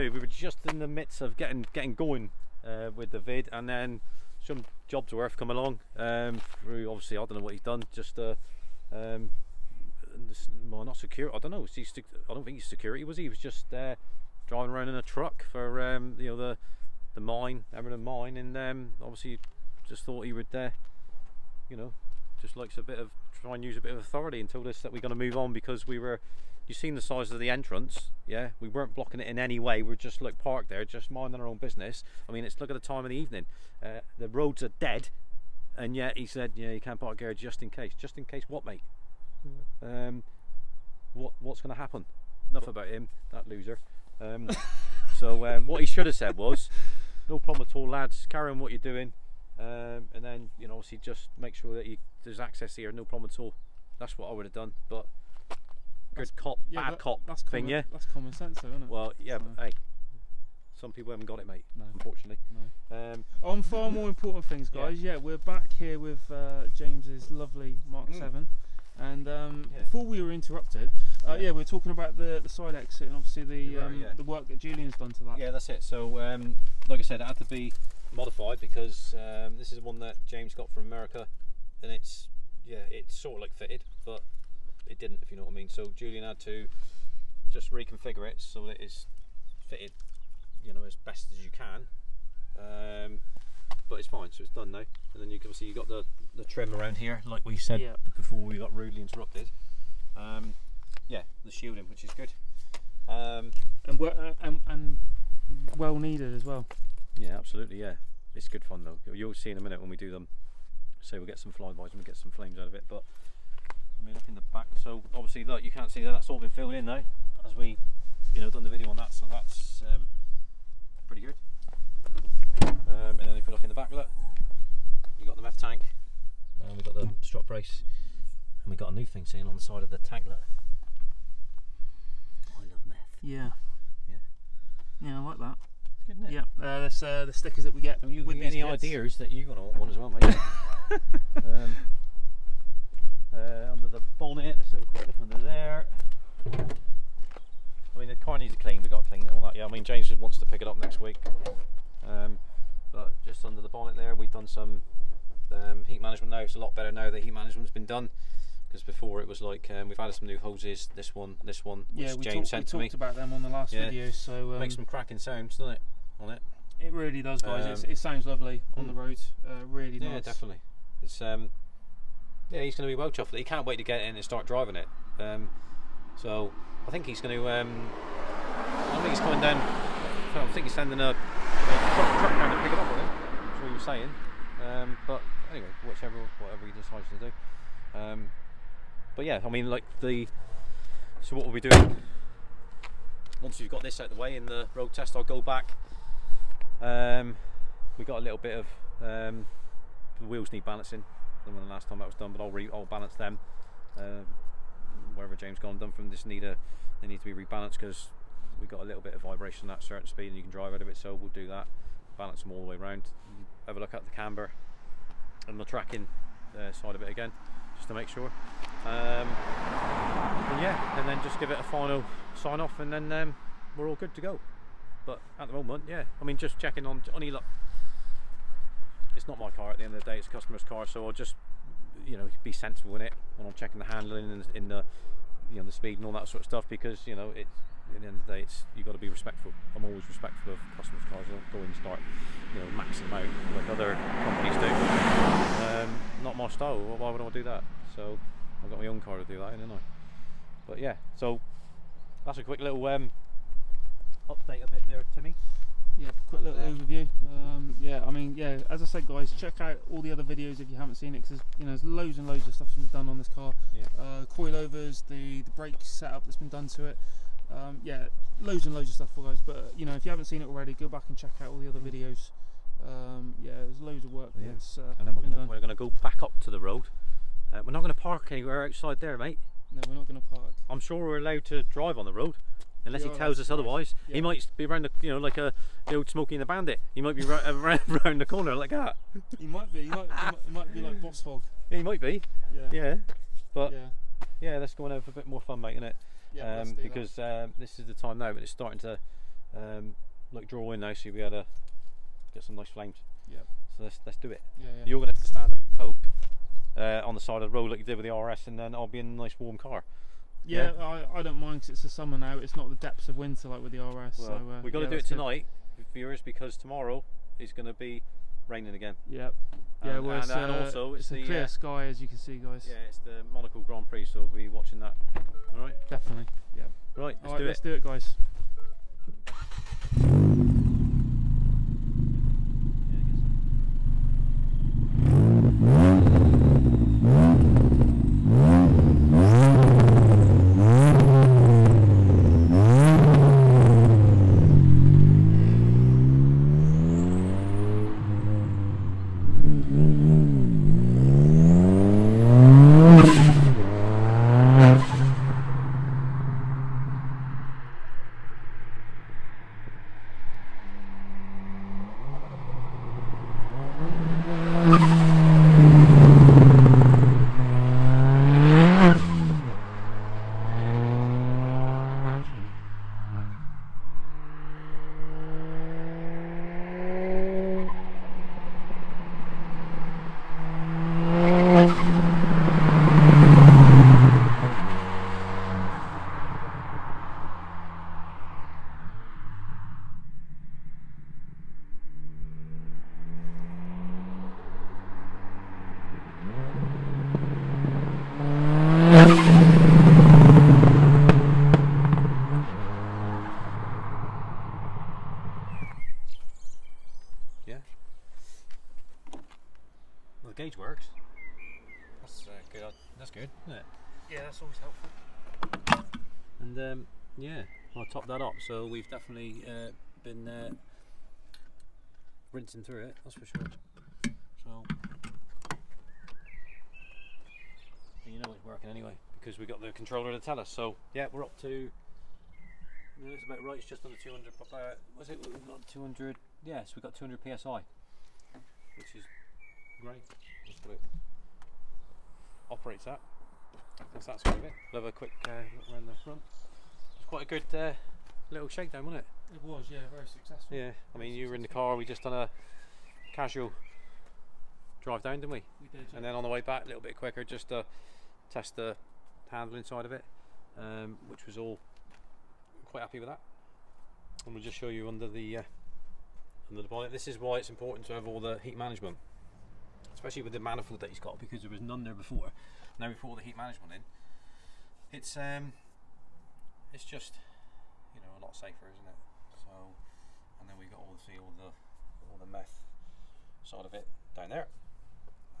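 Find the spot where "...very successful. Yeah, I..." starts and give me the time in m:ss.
7:29.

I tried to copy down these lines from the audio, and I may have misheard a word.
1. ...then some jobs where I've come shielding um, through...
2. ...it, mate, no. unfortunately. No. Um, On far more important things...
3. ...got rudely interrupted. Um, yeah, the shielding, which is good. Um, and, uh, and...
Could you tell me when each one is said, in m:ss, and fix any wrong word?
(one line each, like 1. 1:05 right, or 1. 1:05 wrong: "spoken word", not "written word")
1. 0:03 wrong: "along", not "shielding"
2. 1:01 right
3. 1:38 right.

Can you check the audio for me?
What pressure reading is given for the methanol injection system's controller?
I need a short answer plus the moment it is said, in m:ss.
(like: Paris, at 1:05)
200 psi, at 7:16.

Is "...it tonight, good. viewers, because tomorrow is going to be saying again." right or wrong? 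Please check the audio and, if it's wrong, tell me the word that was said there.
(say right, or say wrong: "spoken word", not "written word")
wrong: "raining", not "saying".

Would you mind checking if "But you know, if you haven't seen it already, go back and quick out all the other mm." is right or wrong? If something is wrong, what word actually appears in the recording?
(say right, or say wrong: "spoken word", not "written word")
wrong: "check", not "quick".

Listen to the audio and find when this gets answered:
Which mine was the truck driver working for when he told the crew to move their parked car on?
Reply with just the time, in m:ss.
0:17.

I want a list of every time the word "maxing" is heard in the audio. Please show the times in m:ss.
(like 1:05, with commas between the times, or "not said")
4:02.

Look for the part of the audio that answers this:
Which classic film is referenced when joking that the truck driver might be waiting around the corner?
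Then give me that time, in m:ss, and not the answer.
4:46.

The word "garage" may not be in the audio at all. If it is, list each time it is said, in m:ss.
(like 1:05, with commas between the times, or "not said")
0:37.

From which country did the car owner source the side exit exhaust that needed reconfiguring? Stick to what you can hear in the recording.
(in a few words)
America.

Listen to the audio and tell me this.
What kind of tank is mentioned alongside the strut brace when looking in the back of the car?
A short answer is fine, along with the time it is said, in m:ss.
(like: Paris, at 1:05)
meth tank, at 2:05.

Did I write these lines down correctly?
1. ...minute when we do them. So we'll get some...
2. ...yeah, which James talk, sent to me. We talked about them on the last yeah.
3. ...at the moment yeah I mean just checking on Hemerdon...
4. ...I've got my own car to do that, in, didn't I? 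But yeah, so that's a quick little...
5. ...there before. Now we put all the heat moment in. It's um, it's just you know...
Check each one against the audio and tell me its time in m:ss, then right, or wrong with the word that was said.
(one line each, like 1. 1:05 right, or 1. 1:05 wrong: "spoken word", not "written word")
1. 1:49 right
2. 2:41 right
3. 3:45 wrong: "Johnny", not "Hemerdon"
4. 4:08 right
5. 7:51 wrong: "management", not "moment".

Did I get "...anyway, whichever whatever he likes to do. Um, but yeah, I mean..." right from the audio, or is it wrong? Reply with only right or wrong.
wrong.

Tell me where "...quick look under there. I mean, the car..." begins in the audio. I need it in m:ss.
2:24.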